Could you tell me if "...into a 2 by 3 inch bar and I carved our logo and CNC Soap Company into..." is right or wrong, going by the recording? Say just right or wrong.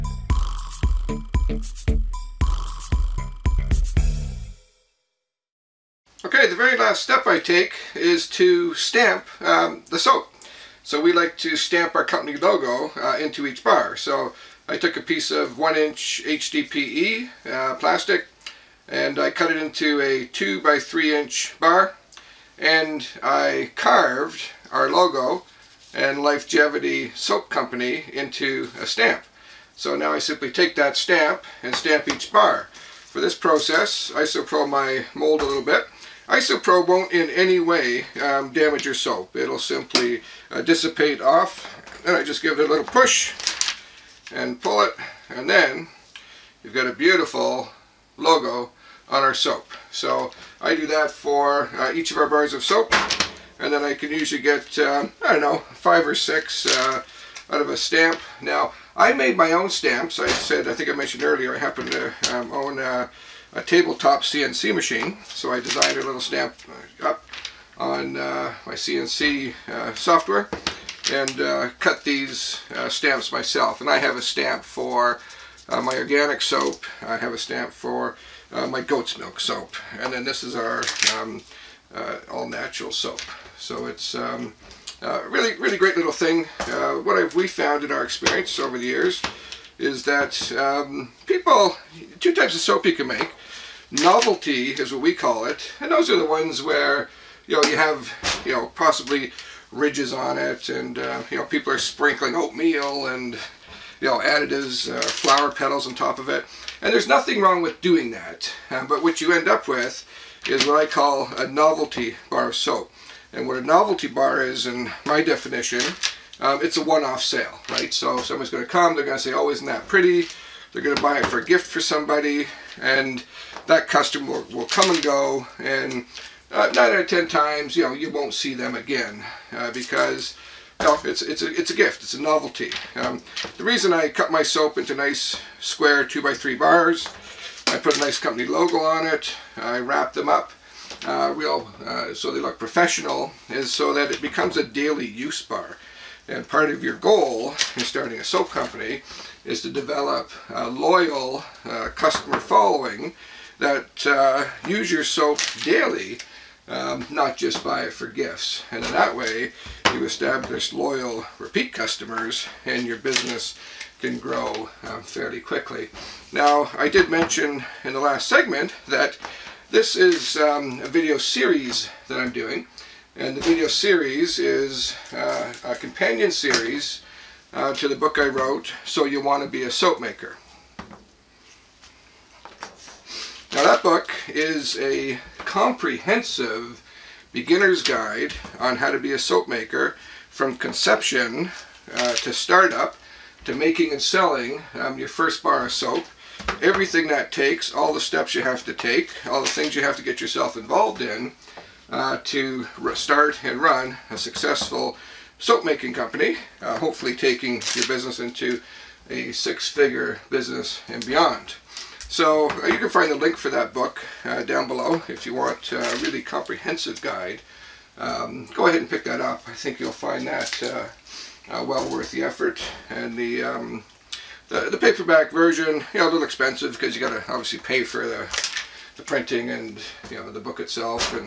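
wrong.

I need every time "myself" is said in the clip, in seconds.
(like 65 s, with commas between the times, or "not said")
73 s.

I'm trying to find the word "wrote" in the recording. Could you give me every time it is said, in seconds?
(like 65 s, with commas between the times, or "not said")
178 s.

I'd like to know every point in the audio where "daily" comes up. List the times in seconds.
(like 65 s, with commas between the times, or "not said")
144 s, 155 s.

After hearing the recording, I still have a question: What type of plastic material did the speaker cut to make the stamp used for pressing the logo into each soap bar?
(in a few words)
HDPE.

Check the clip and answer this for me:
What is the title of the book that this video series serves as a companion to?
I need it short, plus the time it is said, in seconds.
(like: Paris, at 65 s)
So You Want to Be a Soap Maker, at 178 s.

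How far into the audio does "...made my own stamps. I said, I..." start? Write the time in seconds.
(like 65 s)
59 s.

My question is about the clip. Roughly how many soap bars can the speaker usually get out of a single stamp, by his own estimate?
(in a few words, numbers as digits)
5 or 6.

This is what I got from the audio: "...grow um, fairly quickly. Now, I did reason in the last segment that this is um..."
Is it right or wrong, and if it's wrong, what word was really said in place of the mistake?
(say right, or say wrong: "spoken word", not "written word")
wrong: "mention", not "reason".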